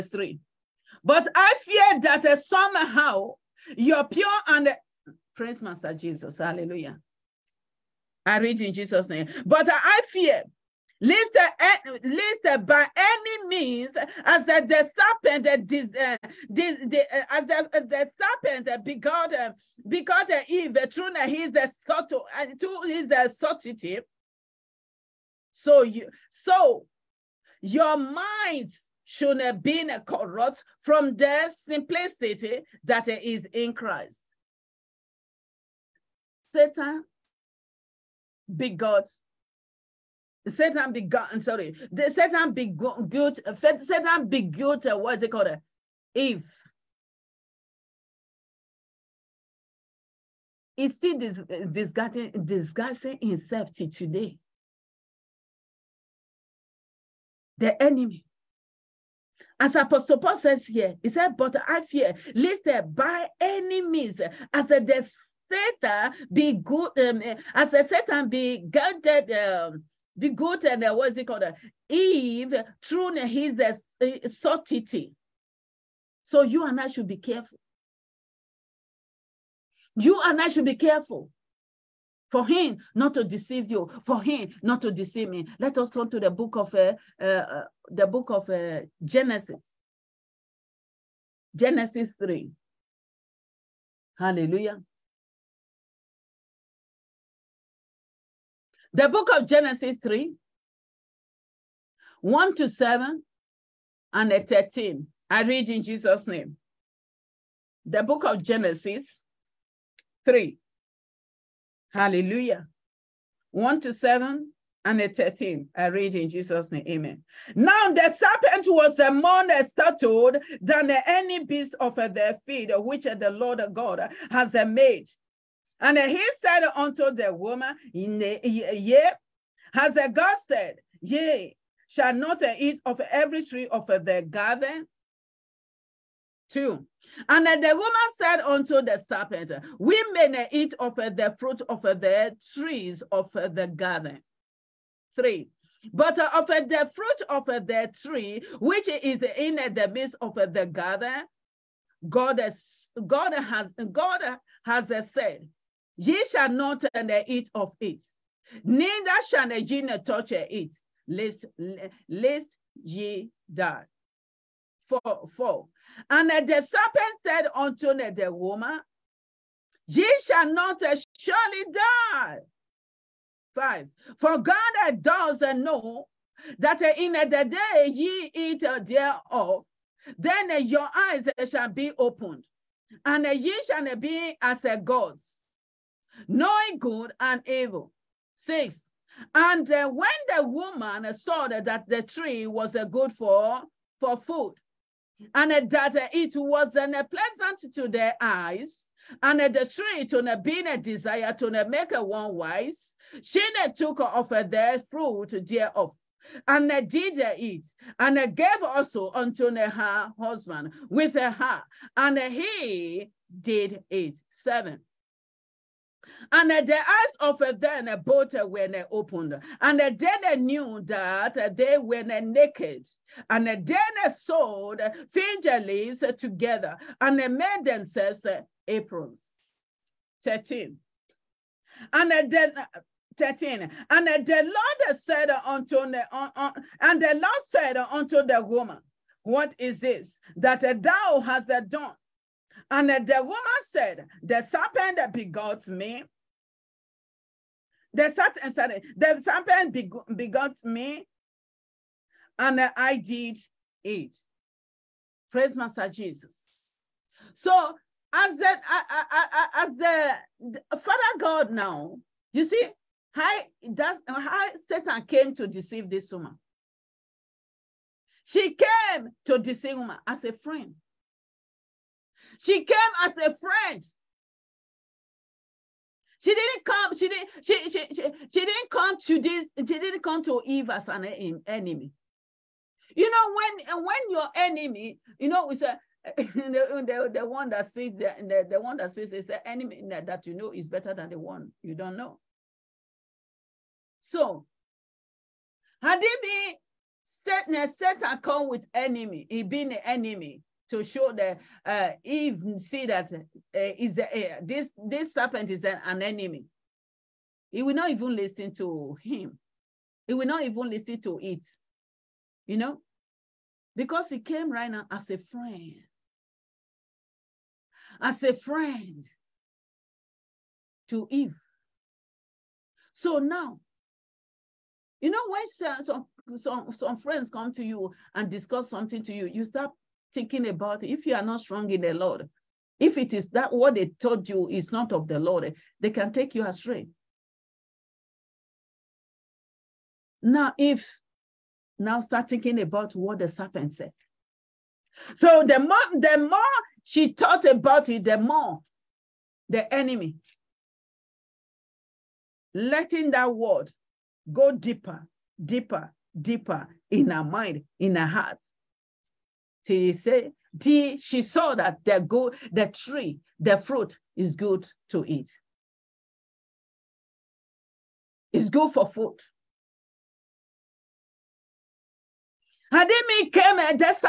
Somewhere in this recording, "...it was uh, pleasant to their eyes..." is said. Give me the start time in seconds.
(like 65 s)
196 s.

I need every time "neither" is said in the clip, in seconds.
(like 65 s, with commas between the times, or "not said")
158 s.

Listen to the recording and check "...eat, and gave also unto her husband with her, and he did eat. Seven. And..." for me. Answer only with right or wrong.
right.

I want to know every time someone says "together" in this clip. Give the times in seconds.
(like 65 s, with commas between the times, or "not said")
226 s.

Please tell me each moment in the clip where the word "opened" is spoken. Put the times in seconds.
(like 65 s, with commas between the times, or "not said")
181 s, 218 s.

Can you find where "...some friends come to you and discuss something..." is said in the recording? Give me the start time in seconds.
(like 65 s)
326 s.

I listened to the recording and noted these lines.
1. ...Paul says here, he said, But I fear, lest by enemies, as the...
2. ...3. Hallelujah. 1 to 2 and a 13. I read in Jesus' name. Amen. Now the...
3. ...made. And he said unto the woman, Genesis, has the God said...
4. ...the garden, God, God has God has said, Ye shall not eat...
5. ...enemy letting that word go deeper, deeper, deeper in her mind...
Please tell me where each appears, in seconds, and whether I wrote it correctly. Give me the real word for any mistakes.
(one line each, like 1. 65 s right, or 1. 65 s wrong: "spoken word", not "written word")
1. 60 s right
2. 110 s wrong: "7", not "2"
3. 124 s wrong: "Yea", not "Genesis"
4. 150 s right
5. 349 s right.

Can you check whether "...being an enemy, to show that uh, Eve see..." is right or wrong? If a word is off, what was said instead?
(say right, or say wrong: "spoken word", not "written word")
right.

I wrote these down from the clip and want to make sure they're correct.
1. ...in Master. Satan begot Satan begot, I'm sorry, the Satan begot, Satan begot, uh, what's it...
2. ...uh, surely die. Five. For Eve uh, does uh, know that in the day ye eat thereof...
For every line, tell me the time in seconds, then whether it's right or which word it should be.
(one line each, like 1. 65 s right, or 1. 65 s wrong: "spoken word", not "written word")
1. 33 s wrong: "Christ", not "Master"
2. 170 s wrong: "God", not "Eve".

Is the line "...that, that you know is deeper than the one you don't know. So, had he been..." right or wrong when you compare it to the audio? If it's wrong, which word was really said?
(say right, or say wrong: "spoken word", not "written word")
wrong: "better", not "deeper".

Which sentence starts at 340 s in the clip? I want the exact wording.
Now, if now start thinking about what the serpent said.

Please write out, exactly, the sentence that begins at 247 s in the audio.
The serpent, eh, sorry, the serpent begot me, and I did it.